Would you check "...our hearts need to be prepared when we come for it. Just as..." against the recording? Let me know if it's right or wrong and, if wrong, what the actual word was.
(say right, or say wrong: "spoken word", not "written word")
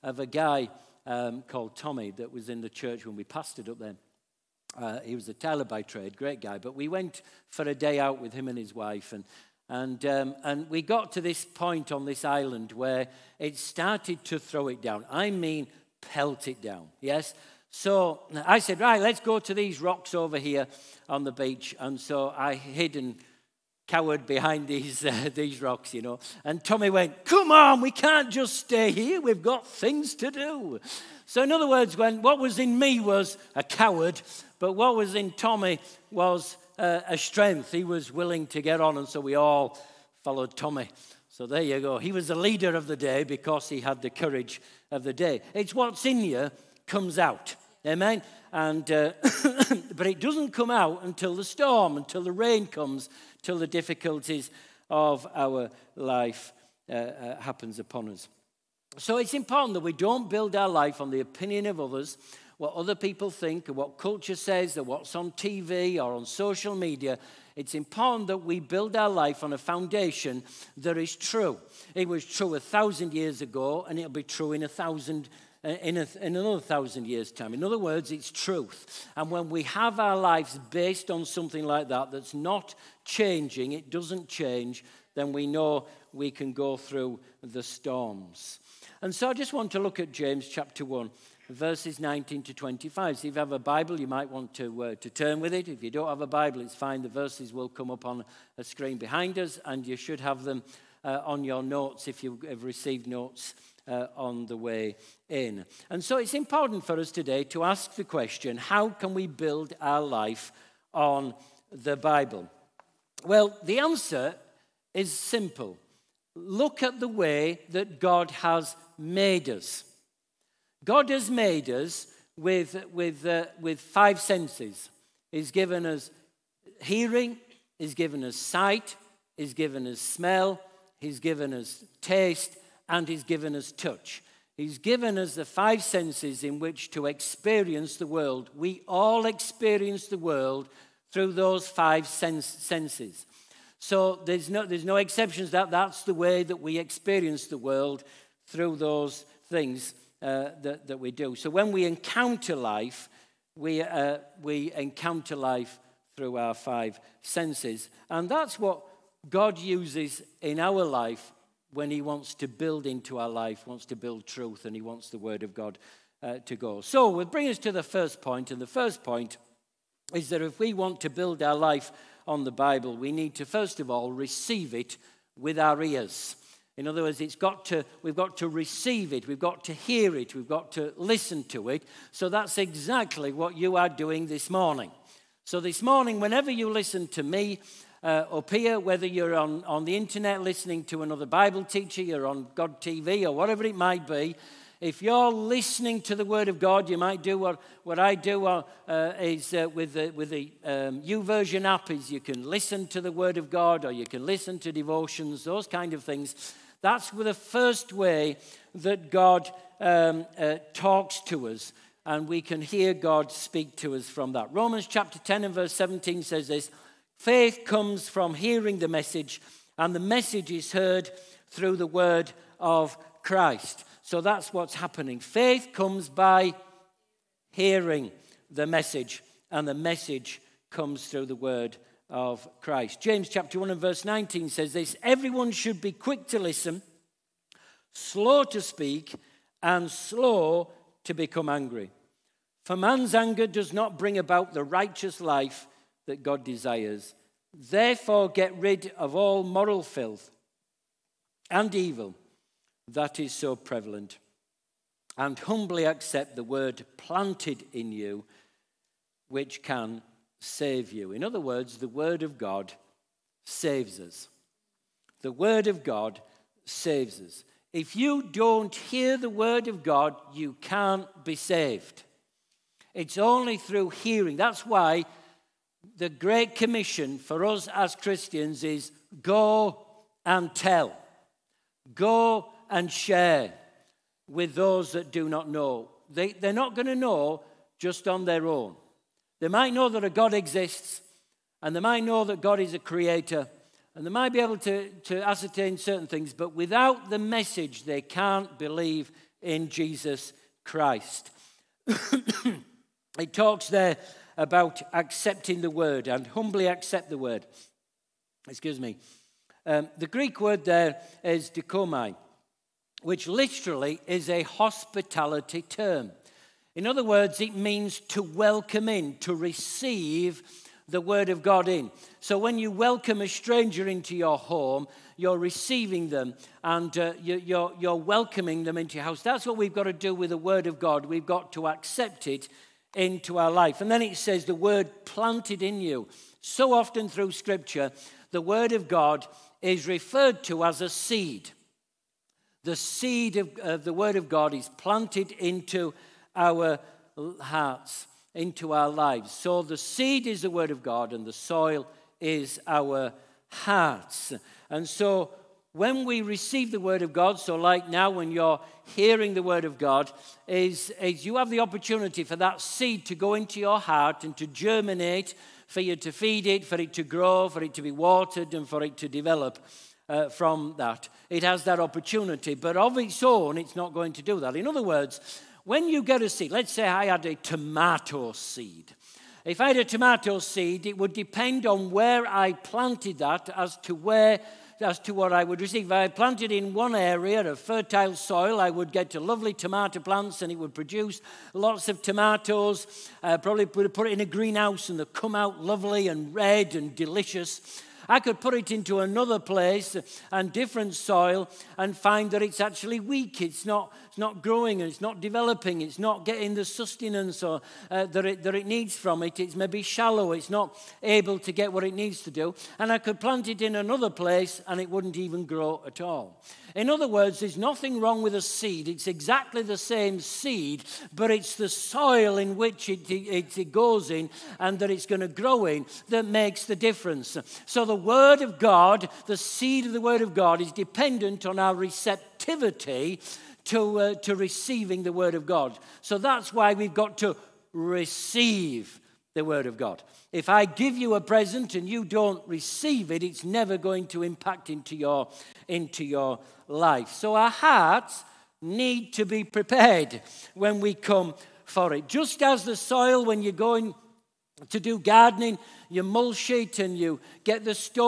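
right.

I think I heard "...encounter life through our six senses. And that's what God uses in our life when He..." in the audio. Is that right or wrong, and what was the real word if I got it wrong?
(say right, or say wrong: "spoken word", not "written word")
wrong: "five", not "six".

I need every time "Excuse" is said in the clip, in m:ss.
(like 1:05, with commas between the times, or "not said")
5:08.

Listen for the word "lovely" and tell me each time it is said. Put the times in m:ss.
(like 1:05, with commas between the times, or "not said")
6:29, 6:35.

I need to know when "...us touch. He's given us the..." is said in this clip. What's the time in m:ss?
2:13.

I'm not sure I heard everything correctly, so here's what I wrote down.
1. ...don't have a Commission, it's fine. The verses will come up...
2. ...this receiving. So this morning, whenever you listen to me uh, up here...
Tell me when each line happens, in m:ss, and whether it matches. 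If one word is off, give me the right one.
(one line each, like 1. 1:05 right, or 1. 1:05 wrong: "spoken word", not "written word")
1. 1:35 wrong: "Bible", not "Commission"
2. 3:04 wrong: "morning", not "receiving".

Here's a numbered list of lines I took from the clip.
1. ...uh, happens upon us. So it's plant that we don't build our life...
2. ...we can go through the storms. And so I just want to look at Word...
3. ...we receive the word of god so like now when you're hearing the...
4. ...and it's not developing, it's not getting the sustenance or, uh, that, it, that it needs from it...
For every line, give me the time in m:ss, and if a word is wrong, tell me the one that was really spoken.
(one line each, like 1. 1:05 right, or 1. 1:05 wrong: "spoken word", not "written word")
1. 0:56 wrong: "important", not "plant"
2. 1:26 wrong: "James", not "Word"
3. 5:56 right
4. 6:44 right.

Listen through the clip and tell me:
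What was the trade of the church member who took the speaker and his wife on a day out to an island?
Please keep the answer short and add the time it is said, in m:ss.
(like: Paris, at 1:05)
Tailor, at 0:05.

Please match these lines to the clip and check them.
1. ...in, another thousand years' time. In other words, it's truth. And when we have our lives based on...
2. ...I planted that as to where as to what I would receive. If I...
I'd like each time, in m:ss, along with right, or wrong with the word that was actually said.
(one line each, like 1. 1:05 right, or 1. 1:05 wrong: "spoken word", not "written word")
1. 1:16 right
2. 6:22 right.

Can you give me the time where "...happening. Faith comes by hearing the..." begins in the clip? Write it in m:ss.
3:44.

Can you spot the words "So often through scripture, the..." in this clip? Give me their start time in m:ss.
5:36.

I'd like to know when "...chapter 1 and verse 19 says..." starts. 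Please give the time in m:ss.
3:53.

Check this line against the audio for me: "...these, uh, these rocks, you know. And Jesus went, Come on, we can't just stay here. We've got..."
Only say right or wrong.
wrong.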